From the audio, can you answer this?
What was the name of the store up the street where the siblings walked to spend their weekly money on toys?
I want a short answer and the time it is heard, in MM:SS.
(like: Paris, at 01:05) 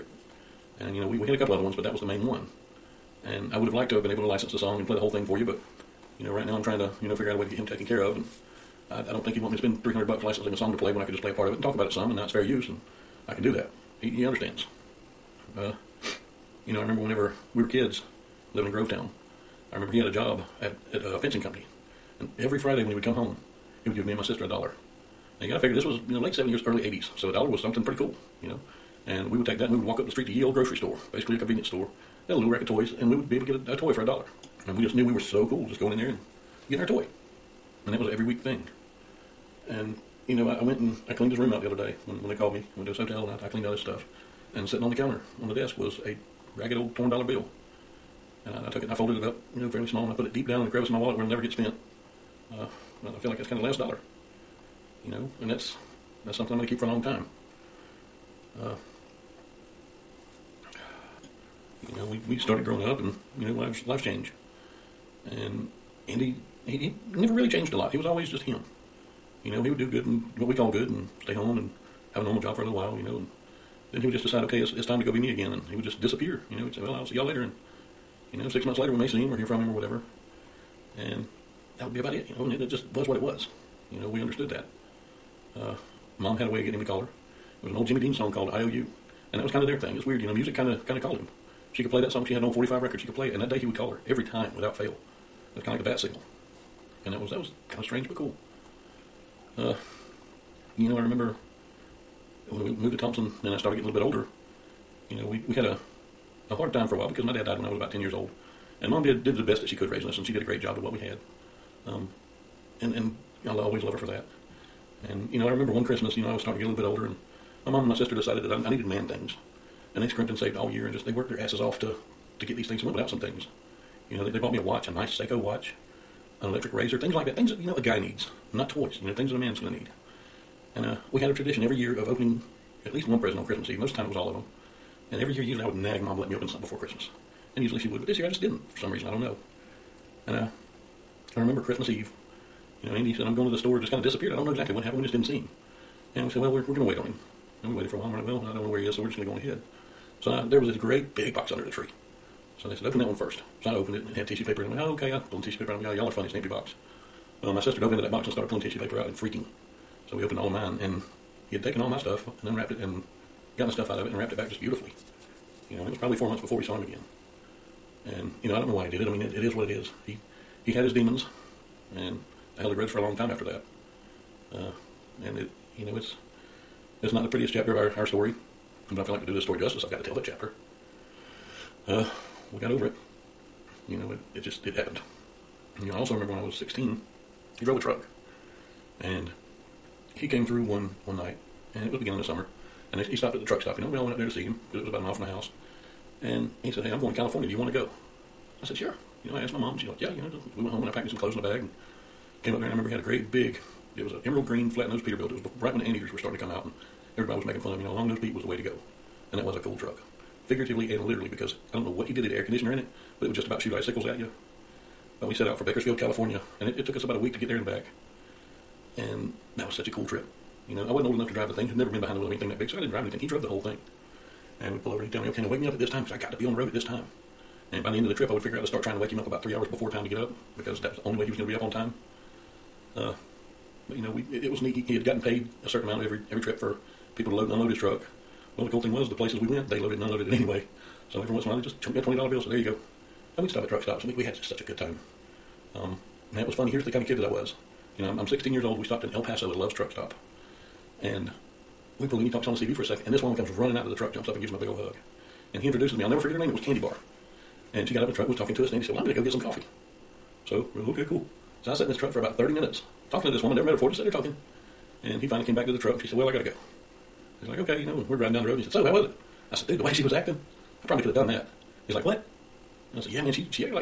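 Ye Old Grocery Store, at 00:30.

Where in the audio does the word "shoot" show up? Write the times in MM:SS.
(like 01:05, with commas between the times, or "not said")
03:33.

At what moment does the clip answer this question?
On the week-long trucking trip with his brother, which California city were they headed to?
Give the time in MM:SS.
03:35.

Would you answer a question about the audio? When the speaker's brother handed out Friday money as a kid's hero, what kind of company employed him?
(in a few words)
a fencing company.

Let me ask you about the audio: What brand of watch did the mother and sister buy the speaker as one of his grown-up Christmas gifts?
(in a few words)
Seiko.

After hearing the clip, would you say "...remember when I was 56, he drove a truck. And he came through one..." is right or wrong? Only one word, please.
wrong.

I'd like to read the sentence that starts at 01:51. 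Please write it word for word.
Um, and and I'll always love her for that.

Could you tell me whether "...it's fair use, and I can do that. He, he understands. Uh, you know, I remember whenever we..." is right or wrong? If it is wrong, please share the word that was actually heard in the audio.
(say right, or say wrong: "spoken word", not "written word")
right.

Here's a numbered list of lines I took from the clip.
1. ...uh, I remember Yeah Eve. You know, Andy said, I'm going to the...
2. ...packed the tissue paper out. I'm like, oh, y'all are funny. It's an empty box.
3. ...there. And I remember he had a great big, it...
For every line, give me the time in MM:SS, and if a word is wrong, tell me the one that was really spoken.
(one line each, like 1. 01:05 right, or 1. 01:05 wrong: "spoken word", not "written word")
1. 02:20 wrong: "Christmas", not "Yeah"
2. 02:35 wrong: "pulled", not "packed"
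3. 03:22 right.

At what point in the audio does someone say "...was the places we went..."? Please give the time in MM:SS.
03:58.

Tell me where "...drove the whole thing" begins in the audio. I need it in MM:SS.
03:43.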